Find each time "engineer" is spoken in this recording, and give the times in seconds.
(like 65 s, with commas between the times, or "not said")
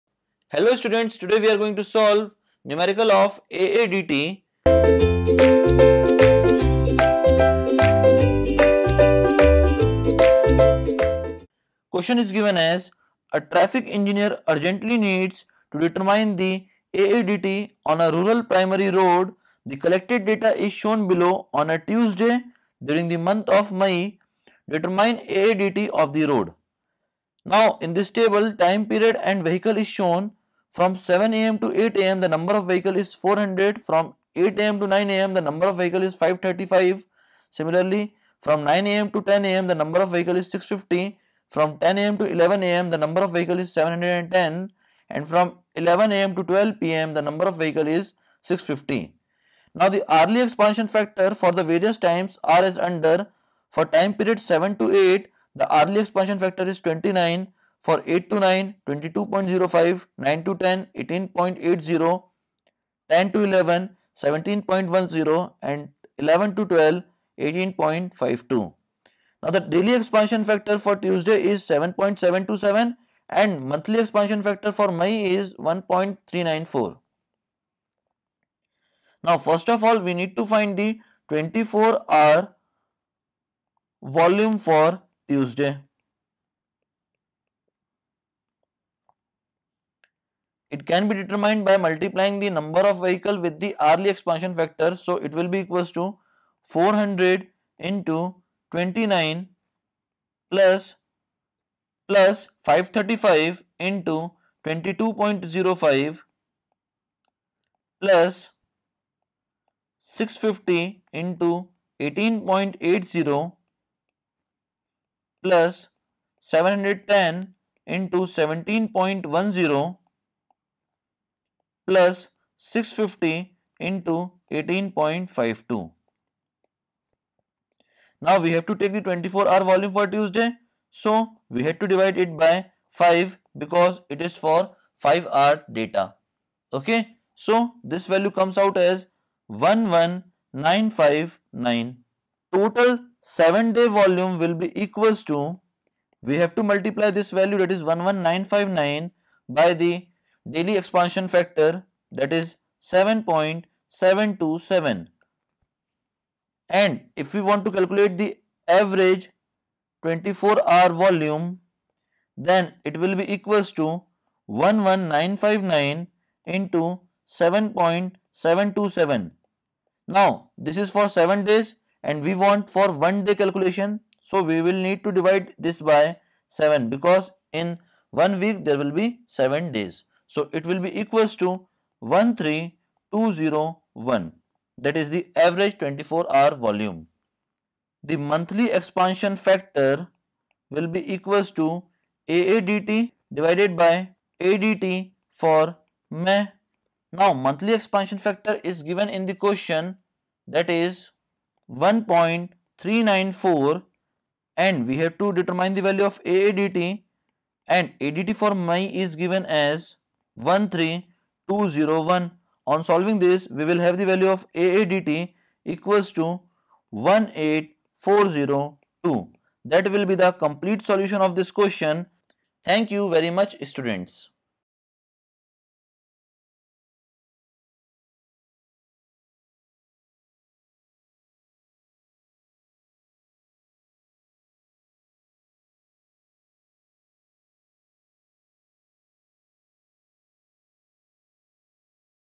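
13 s.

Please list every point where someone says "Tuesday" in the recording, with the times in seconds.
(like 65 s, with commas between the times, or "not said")
21 s, 70 s, 85 s, 130 s.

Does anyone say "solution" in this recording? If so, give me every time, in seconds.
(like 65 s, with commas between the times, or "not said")
220 s.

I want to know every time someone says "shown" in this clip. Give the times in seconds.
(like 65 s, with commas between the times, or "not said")
20 s, 29 s.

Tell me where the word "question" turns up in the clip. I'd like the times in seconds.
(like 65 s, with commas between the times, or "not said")
11 s, 199 s, 221 s.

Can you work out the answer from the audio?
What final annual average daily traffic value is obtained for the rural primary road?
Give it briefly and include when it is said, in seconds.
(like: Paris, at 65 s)
18402, at 216 s.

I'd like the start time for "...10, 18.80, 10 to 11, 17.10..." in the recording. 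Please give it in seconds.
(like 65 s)
60 s.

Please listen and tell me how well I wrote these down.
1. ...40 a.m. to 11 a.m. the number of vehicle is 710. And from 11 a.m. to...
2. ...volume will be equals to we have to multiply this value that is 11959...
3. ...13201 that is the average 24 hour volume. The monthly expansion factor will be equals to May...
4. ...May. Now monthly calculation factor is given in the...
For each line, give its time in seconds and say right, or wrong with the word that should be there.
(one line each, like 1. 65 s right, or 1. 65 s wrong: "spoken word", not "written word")
1. 41 s wrong: "10", not "40"
2. 143 s right
3. 182 s wrong: "AADT", not "May"
4. 196 s wrong: "expansion", not "calculation".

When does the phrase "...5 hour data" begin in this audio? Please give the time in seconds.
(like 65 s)
135 s.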